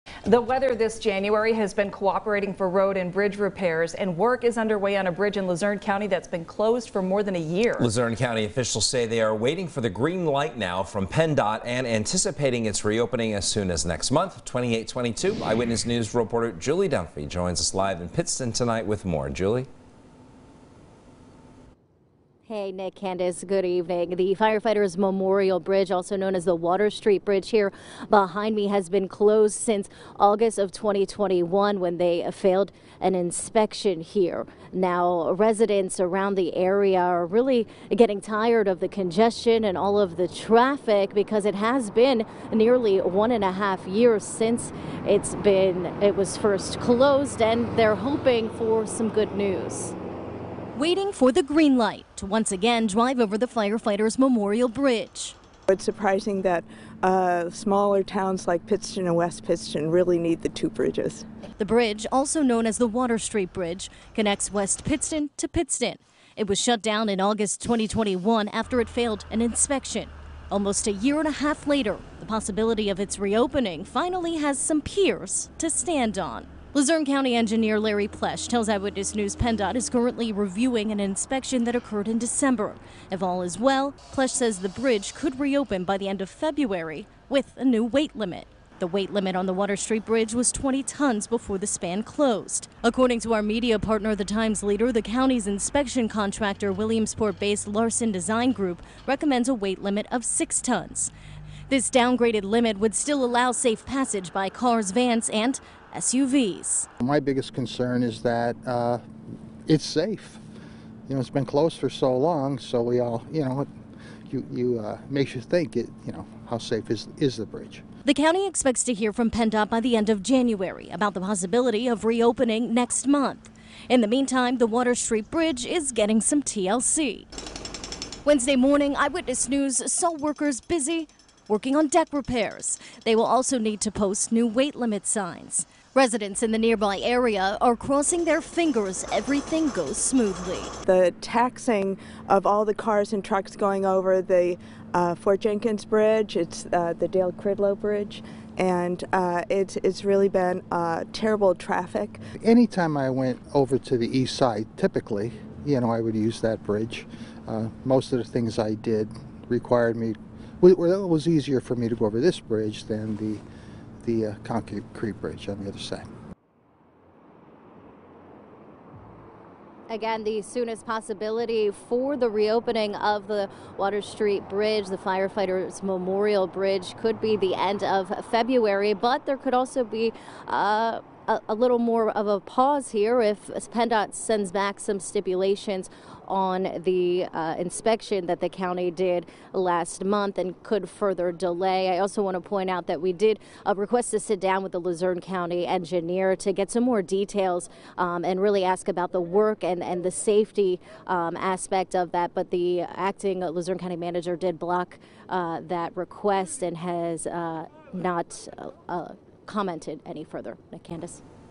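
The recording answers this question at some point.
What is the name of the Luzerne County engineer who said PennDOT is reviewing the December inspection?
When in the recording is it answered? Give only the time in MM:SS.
01:17.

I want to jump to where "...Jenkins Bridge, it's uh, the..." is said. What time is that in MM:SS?
02:25.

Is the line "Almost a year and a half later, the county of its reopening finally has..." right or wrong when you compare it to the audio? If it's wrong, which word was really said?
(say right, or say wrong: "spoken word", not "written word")
wrong: "possibility", not "county".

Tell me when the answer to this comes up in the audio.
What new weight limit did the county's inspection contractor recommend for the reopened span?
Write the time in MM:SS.
01:40.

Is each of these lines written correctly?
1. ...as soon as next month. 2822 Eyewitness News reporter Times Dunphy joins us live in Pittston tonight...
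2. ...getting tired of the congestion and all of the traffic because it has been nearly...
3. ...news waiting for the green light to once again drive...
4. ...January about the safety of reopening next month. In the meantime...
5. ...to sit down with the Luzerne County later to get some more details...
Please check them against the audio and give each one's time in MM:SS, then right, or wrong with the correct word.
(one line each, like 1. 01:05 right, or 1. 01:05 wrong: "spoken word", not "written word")
1. 00:13 wrong: "Julie", not "Times"
2. 00:37 right
3. 00:49 right
4. 02:00 wrong: "possibility", not "safety"
5. 03:14 wrong: "engineer", not "later".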